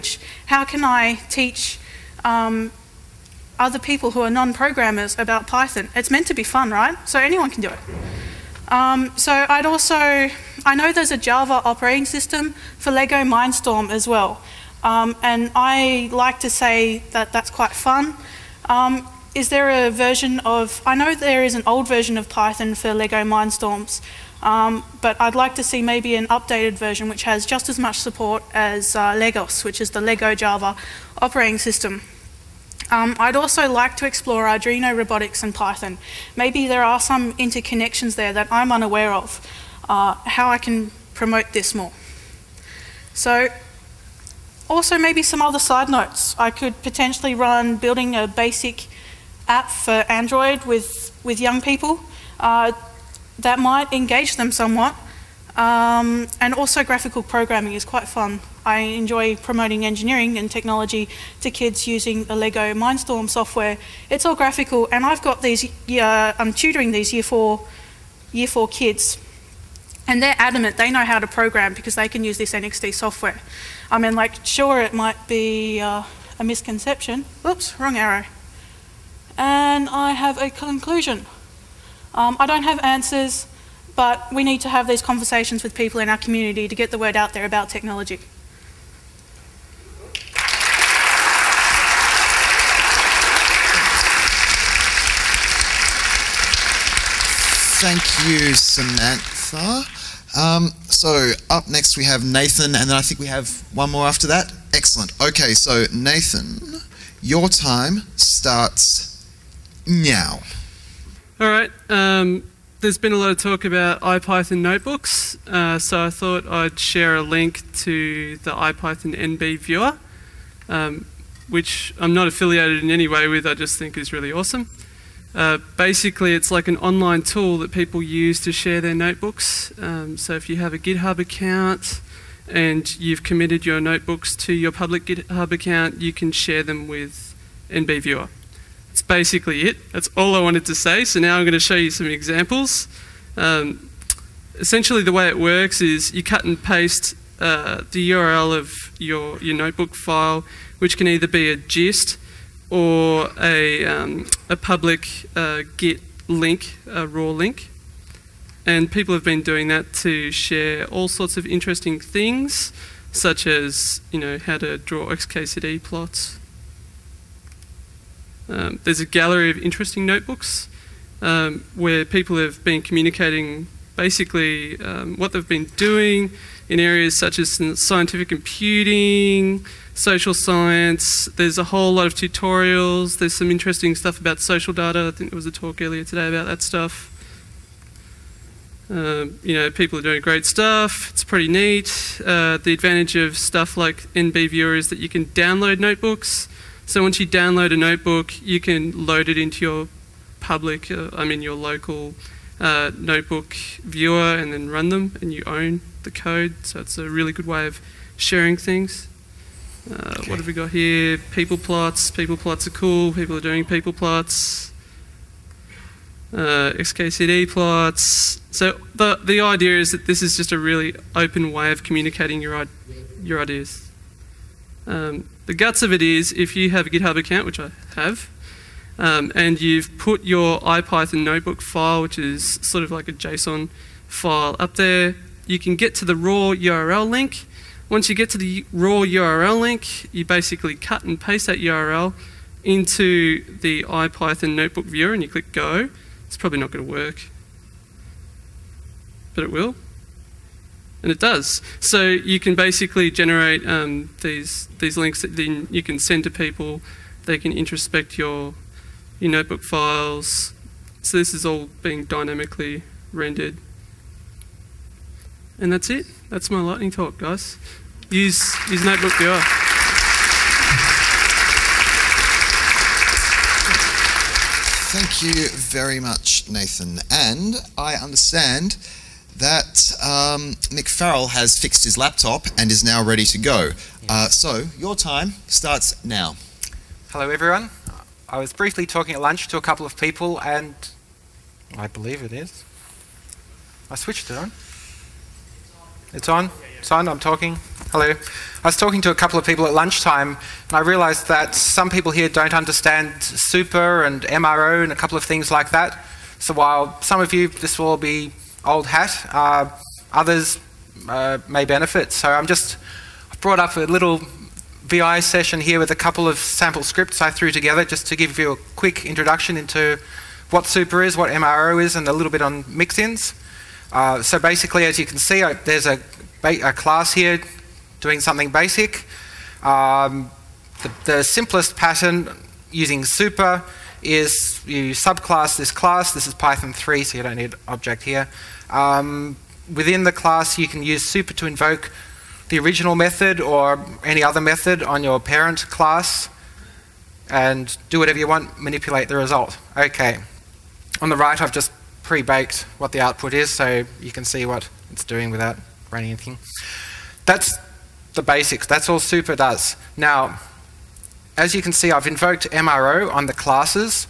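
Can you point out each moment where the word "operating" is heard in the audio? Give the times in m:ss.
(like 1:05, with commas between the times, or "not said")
0:11, 0:31.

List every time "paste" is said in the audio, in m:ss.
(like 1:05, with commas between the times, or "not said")
2:26, 4:01.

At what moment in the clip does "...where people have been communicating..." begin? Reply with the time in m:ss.
2:51.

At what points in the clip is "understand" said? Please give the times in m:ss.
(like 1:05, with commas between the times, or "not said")
4:37, 5:02.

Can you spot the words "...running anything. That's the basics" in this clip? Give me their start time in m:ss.
5:55.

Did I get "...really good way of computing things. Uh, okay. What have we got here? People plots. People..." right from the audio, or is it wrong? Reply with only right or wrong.
wrong.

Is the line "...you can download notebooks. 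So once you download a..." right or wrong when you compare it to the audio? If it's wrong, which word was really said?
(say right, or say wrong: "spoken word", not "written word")
right.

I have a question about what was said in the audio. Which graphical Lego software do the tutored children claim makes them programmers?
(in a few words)
NXT software.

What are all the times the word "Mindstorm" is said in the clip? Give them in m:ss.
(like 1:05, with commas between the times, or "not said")
0:13, 0:23, 1:02.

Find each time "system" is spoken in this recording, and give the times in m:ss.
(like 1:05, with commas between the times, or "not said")
0:12, 0:31.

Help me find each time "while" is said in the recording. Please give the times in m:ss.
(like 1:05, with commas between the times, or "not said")
5:06.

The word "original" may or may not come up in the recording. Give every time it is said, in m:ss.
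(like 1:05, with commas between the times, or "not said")
5:42.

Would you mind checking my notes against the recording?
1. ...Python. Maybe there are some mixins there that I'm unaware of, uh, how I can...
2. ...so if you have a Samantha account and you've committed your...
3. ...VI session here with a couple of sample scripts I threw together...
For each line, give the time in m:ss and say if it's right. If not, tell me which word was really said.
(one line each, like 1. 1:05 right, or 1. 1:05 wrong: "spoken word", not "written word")
1. 0:35 wrong: "interconnections", not "mixins"
2. 2:10 wrong: "GitHub", not "Samantha"
3. 5:14 right.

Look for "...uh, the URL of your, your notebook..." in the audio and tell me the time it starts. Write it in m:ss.
2:27.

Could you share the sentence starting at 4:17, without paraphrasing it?
They can introspect your, your notebook files.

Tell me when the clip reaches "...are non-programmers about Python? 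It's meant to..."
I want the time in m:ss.
0:04.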